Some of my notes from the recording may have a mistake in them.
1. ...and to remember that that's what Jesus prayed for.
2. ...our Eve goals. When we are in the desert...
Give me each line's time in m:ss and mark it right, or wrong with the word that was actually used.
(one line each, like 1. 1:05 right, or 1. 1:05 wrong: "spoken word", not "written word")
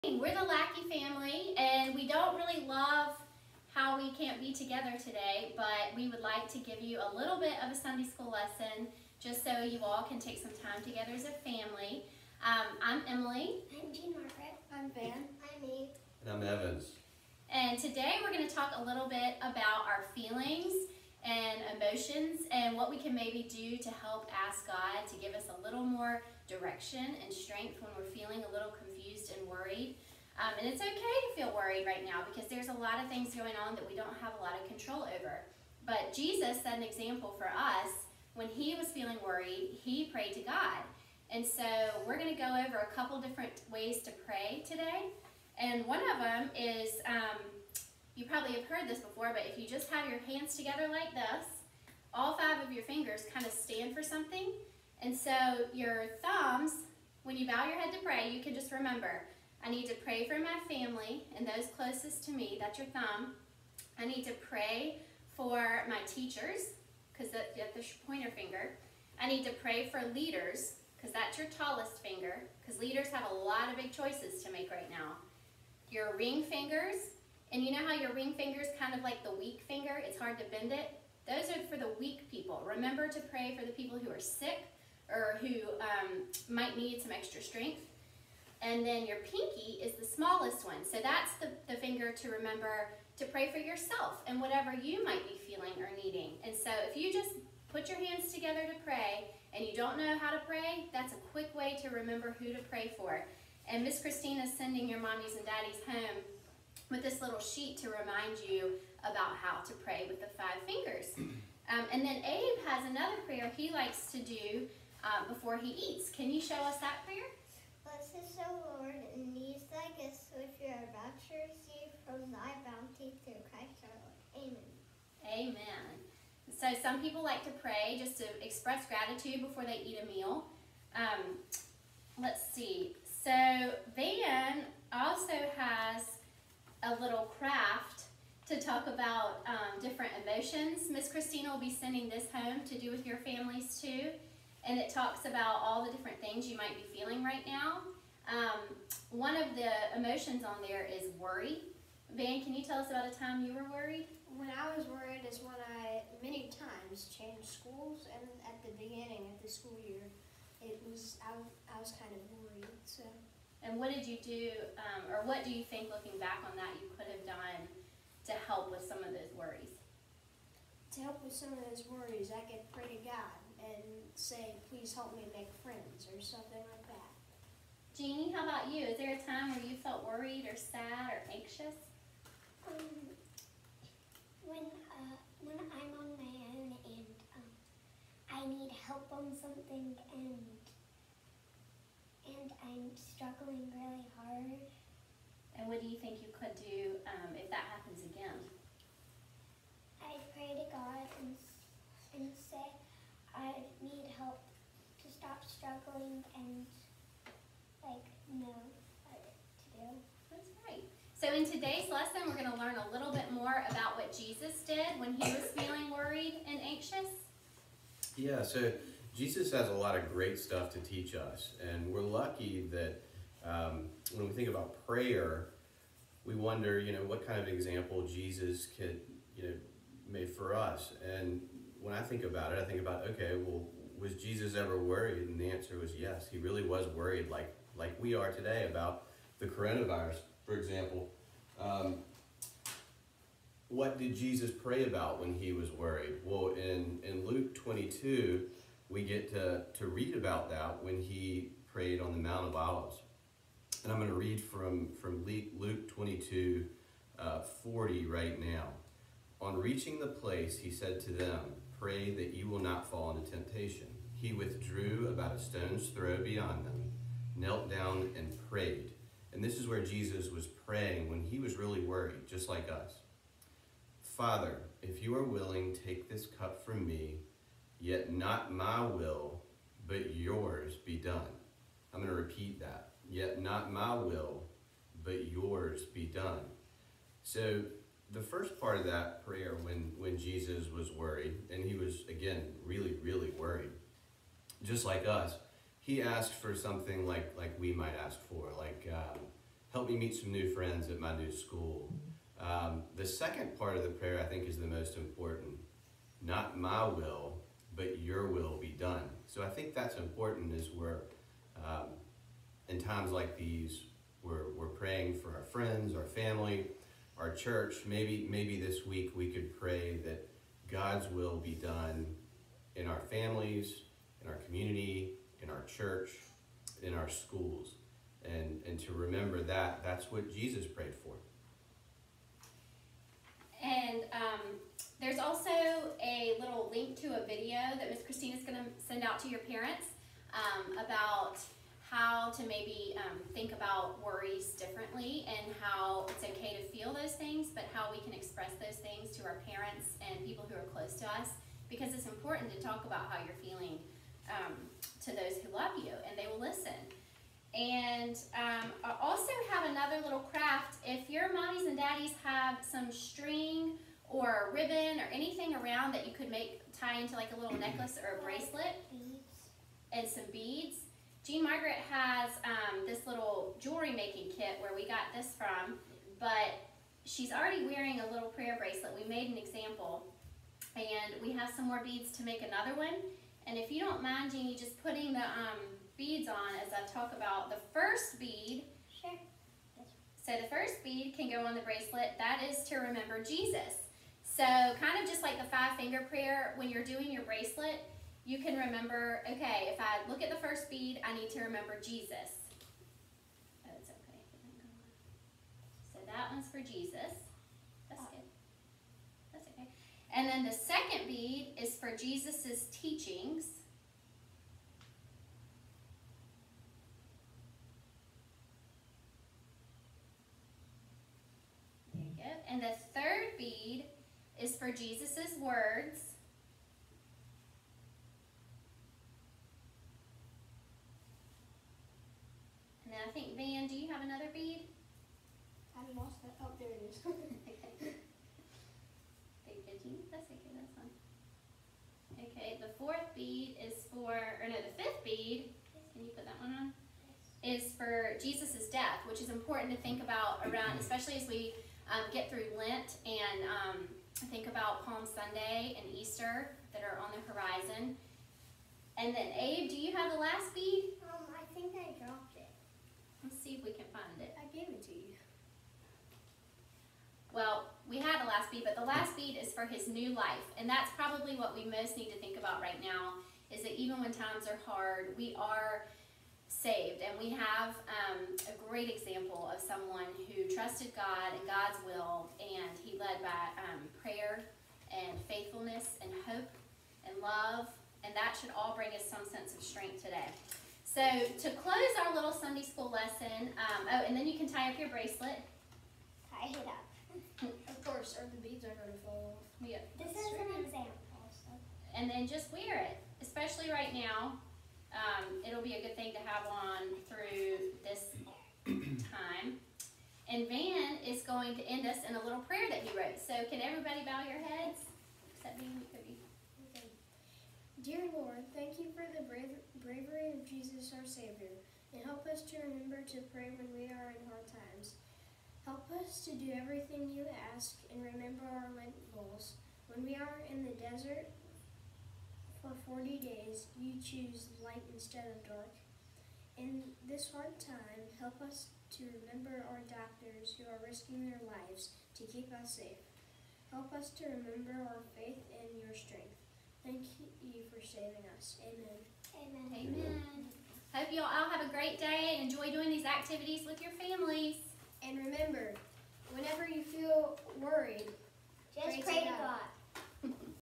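1. 5:28 right
2. 8:48 wrong: "Lent", not "Eve".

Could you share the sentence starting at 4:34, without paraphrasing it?
Father, if you are willing, take this cup from me, yet not my will, but yours be done.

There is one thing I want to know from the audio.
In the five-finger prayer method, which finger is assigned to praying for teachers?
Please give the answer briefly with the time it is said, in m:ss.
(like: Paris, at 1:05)
Pointer finger, at 1:08.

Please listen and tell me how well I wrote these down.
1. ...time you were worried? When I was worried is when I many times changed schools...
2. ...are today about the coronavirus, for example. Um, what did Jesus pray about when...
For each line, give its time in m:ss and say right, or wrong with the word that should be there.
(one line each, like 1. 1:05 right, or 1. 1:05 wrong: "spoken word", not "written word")
1. 2:33 right
2. 3:58 right.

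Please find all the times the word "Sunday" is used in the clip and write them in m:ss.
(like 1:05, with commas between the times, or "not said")
0:07, 7:35, 8:12.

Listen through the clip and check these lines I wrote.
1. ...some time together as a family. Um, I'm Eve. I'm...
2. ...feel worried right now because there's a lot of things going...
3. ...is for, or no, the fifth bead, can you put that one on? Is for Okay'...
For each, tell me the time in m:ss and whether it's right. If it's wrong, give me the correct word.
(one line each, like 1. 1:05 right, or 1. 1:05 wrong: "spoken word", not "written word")
1. 0:10 wrong: "Emily", not "Eve"
2. 0:31 right
3. 7:23 wrong: "Jesus", not "Okay".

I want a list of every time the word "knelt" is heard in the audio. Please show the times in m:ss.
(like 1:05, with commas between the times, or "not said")
4:27.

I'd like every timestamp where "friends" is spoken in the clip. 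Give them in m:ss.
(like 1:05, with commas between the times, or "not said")
2:55, 5:00, 5:15.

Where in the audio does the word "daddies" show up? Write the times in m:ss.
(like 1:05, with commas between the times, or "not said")
1:45, 6:01.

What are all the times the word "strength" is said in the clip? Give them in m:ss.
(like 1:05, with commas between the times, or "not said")
0:27, 1:27, 8:09, 9:05.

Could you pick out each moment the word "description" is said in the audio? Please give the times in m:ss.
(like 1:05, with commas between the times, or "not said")
not said.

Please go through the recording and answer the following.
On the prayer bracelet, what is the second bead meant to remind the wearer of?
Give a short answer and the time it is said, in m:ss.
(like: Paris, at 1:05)
Jesus's teachings, at 6:51.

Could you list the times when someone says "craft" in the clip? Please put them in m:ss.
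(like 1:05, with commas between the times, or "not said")
2:17, 6:00.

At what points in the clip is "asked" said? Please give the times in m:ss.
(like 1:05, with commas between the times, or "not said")
4:56.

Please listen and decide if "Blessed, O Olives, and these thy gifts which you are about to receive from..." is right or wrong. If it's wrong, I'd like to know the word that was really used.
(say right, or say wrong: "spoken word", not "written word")
wrong: "Lord", not "Olives".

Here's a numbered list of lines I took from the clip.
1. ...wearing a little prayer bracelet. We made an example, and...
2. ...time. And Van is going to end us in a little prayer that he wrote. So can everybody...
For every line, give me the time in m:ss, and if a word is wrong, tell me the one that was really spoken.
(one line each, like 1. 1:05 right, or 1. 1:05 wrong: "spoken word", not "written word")
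1. 6:17 right
2. 8:29 right.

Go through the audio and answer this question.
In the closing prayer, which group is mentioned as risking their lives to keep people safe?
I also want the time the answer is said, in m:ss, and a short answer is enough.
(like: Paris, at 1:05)
Doctors, at 8:59.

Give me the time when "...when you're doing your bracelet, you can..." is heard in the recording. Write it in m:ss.
6:36.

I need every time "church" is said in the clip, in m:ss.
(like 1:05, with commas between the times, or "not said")
5:17, 5:25.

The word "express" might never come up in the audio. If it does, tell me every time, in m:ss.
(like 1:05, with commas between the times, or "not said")
2:08, 5:48.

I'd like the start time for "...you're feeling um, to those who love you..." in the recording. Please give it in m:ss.
5:53.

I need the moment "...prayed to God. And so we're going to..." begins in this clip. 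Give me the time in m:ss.
0:40.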